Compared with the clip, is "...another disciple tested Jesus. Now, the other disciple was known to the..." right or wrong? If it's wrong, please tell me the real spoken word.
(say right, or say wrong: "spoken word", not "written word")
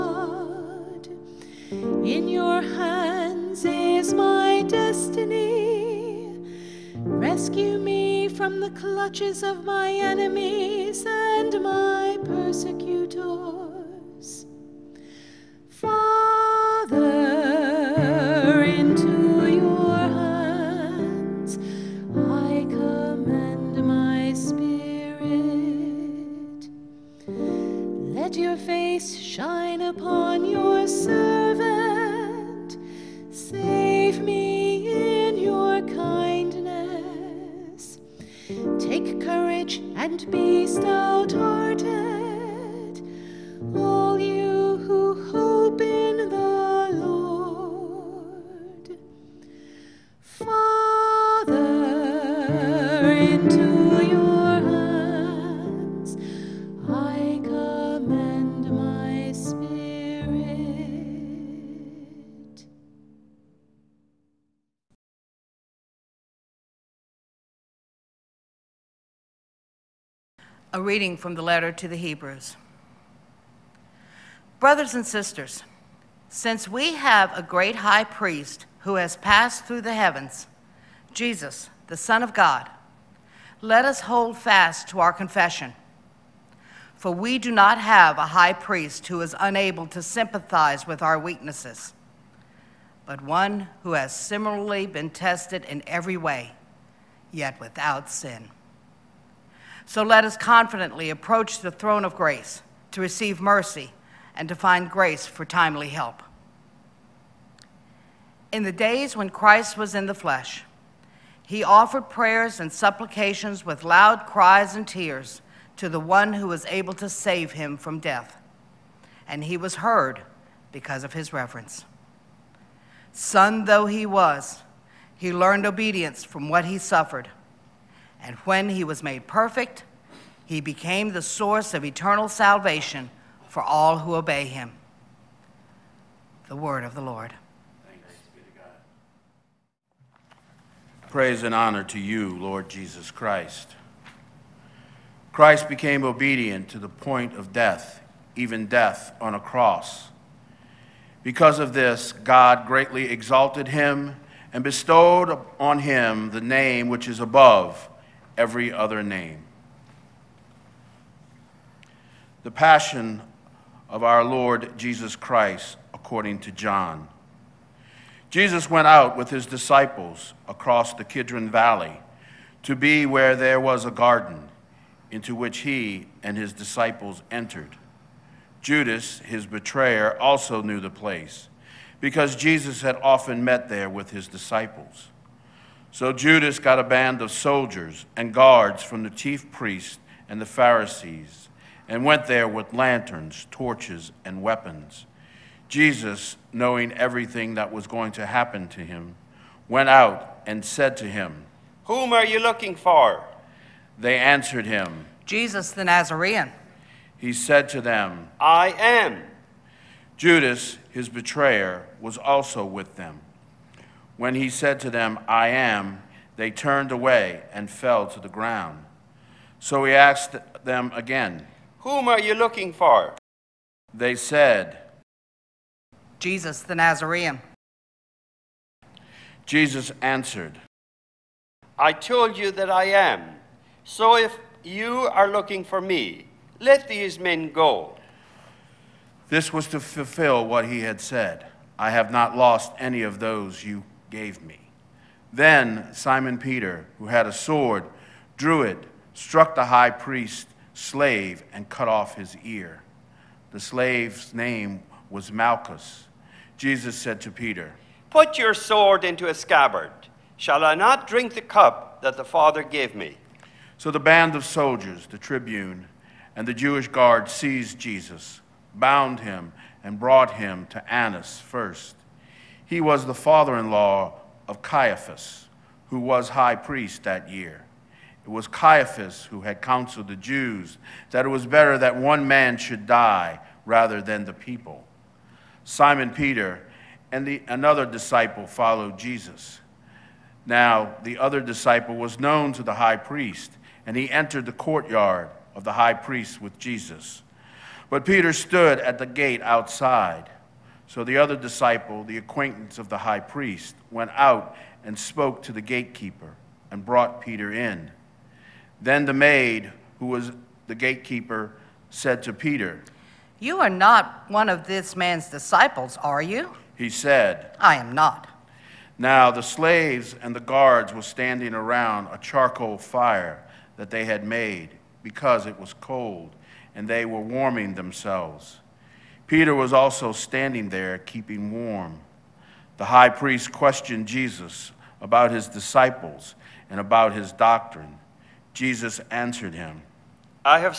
wrong: "followed", not "tested".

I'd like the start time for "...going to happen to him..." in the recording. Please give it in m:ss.
3:17.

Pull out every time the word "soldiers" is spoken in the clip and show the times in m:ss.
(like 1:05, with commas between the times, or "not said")
3:07, 4:24.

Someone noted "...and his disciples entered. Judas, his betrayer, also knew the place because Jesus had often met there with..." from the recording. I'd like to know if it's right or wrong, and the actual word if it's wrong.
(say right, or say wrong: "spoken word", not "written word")
right.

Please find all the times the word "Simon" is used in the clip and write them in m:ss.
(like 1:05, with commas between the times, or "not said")
4:05, 4:45.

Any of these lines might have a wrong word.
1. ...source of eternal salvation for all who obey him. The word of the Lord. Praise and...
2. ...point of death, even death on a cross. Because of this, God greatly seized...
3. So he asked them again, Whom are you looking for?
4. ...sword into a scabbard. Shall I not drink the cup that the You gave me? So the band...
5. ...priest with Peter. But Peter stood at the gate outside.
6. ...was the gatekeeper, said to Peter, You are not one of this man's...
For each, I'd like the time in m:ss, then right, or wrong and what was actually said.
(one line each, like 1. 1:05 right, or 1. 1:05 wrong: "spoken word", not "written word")
1. 2:11 right
2. 2:26 wrong: "exalted", not "seized"
3. 3:39 right
4. 4:18 wrong: "Father", not "You"
5. 4:55 wrong: "Jesus", not "Peter"
6. 5:10 right.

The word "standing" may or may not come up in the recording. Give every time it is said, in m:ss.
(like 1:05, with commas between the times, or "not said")
5:21, 5:30.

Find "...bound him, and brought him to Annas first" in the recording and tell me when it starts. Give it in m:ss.
4:28.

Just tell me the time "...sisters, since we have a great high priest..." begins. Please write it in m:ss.
1:15.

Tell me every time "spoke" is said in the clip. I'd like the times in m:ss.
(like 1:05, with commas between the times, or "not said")
5:04.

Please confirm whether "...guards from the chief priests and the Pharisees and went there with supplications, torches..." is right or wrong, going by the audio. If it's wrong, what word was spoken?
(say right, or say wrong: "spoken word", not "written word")
wrong: "lanterns", not "supplications".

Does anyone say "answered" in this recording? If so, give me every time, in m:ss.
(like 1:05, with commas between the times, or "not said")
3:24, 3:50, 5:39.